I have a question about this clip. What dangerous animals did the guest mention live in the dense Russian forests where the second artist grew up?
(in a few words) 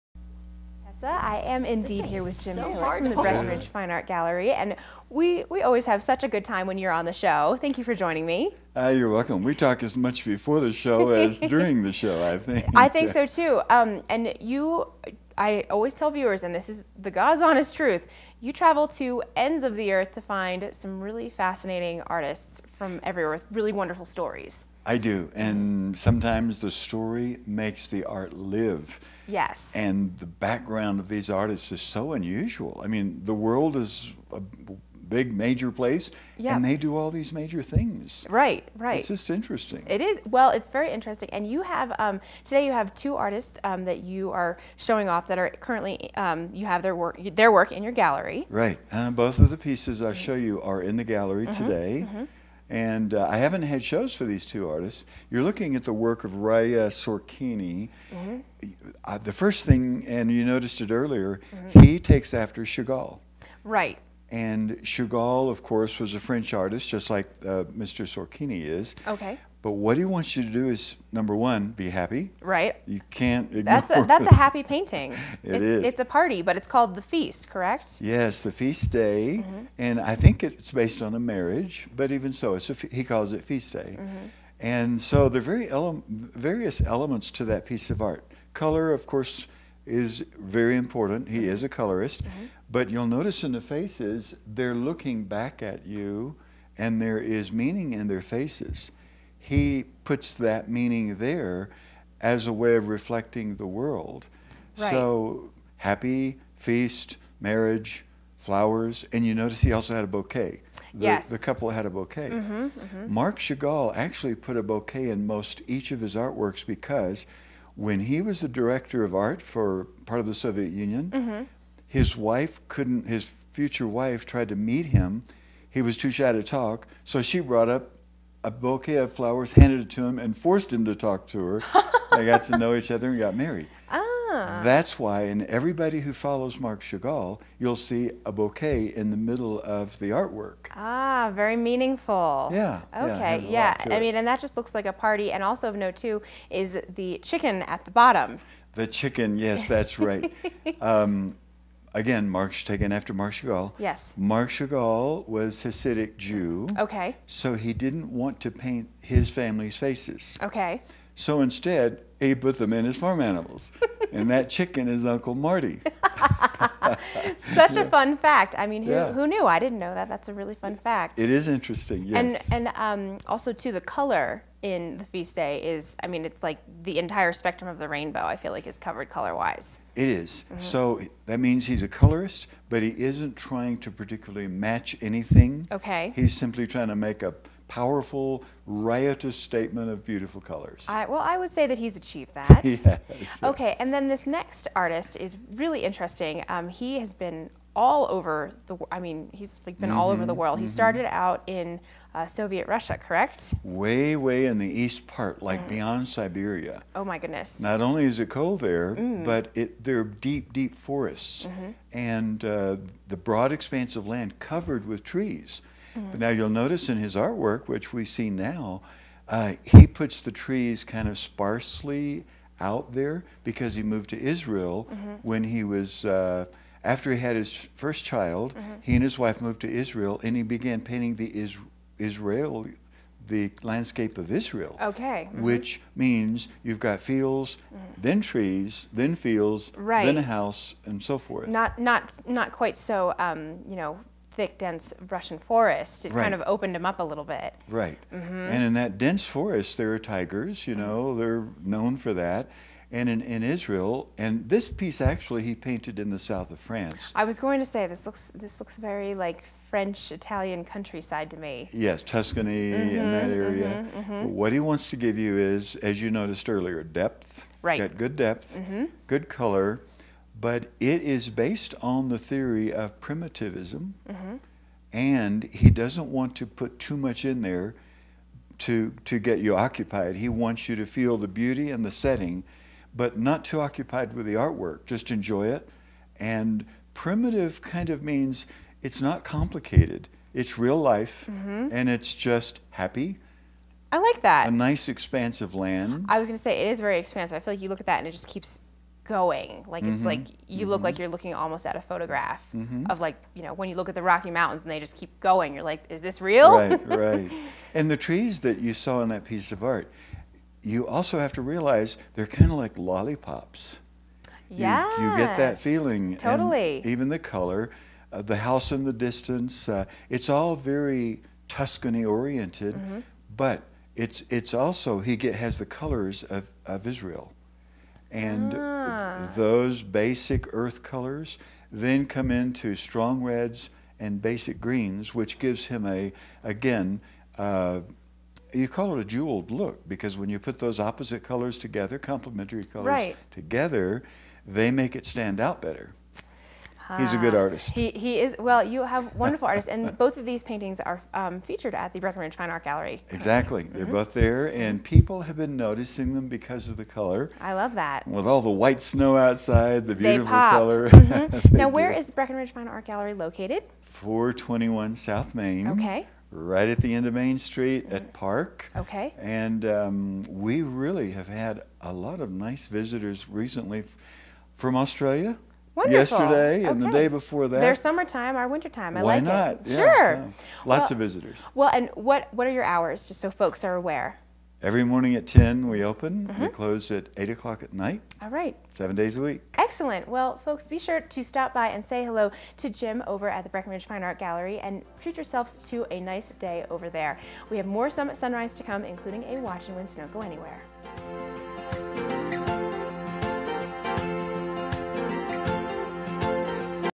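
Tigers.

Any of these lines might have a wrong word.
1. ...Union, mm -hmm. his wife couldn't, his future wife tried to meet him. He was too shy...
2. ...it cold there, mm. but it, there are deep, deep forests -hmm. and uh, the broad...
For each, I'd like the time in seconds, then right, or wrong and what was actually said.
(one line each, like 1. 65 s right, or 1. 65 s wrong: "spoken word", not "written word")
1. 120 s right
2. 208 s right.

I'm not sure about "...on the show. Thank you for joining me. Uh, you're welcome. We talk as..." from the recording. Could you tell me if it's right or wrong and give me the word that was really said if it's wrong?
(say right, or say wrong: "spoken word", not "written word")
right.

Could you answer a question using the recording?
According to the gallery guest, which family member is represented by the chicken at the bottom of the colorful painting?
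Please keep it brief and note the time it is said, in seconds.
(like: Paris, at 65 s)
Uncle Marty, at 165 s.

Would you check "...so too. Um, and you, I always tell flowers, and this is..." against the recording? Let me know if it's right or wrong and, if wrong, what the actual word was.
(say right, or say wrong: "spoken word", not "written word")
wrong: "viewers", not "flowers".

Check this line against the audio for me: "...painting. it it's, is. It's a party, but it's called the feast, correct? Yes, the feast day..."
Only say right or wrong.
right.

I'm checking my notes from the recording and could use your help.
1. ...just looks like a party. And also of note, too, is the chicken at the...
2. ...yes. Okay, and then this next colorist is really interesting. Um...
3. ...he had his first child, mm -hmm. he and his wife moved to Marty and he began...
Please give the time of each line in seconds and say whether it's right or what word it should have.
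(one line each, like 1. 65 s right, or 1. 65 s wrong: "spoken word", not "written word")
1. 144 s right
2. 192 s wrong: "artist", not "colorist"
3. 227 s wrong: "Israel", not "Marty".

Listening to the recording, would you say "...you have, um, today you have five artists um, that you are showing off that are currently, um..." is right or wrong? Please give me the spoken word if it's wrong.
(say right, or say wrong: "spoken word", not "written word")
wrong: "two", not "five".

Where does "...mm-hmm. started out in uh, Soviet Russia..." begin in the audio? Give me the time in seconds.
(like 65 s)
200 s.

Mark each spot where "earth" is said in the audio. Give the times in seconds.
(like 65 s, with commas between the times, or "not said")
19 s, 330 s.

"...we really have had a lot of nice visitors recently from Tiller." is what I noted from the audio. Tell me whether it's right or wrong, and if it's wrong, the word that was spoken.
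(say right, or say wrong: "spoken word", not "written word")
wrong: "Australia", not "Tiller".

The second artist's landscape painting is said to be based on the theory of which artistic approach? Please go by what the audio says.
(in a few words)
Primitivism.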